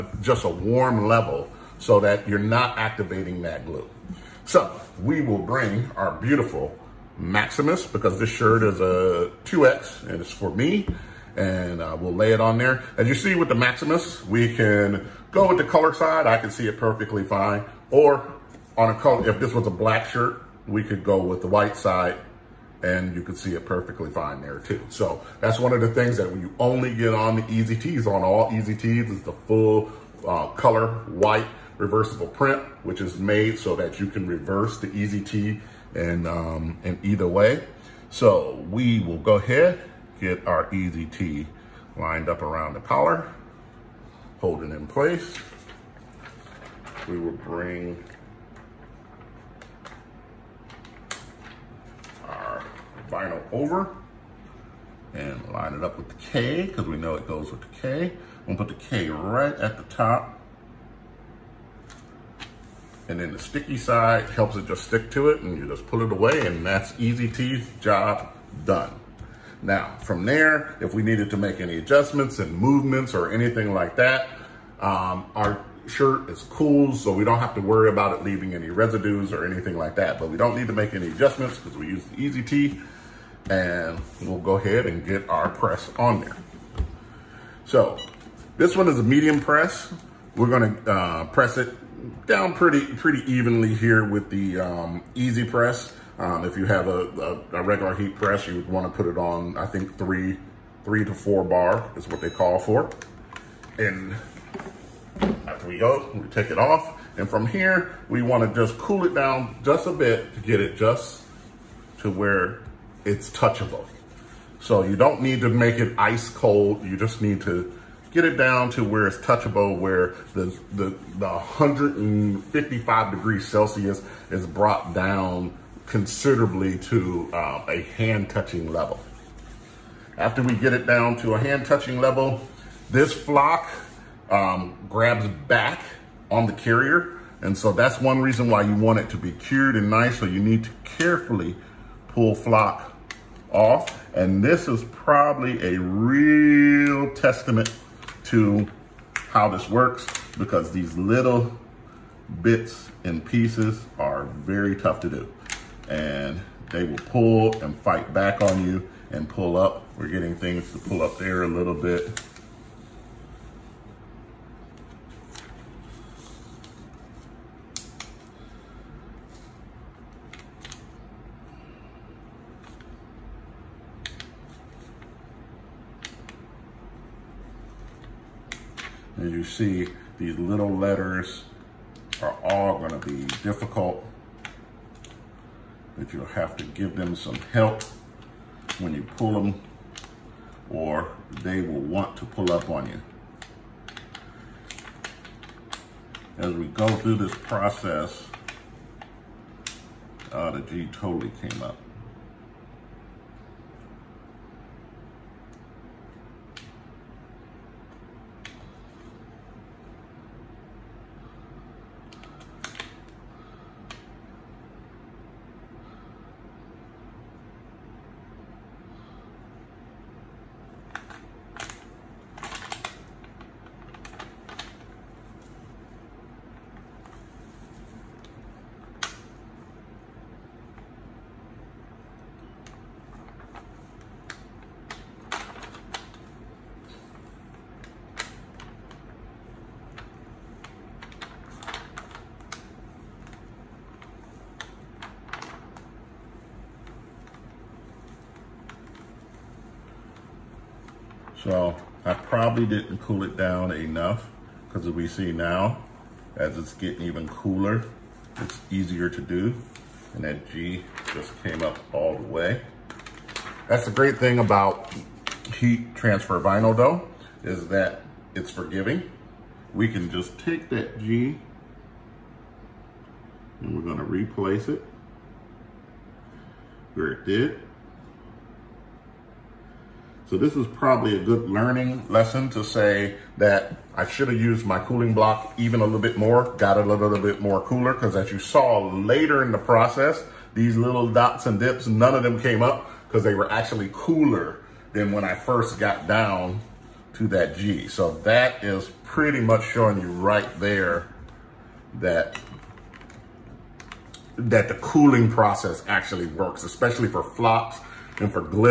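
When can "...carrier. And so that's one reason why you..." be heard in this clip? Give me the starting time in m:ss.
2:16.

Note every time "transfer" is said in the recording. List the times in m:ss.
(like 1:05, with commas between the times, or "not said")
4:25.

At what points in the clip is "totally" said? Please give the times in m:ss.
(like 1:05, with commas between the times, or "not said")
3:20.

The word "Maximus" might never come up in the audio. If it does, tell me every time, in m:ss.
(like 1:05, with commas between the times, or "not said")
0:07, 0:13.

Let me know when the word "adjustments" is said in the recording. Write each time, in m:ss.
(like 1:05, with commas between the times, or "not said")
1:11, 1:21.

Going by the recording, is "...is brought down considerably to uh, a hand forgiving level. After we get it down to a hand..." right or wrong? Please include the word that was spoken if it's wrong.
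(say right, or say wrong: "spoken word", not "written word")
wrong: "touching", not "forgiving".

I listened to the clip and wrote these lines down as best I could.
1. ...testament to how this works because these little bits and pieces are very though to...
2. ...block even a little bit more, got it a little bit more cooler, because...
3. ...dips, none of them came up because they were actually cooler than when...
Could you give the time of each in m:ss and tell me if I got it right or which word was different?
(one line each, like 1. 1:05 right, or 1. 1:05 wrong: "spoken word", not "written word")
1. 2:27 wrong: "tough", not "though"
2. 4:45 right
3. 4:51 right.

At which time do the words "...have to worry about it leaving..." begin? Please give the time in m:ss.
1:17.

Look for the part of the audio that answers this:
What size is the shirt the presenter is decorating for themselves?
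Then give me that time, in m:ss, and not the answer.
0:09.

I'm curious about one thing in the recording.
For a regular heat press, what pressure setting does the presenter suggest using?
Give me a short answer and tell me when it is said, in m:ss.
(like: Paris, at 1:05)
3 to 4 bar, at 1:40.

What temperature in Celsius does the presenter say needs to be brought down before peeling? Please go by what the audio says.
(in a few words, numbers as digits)
155 degrees.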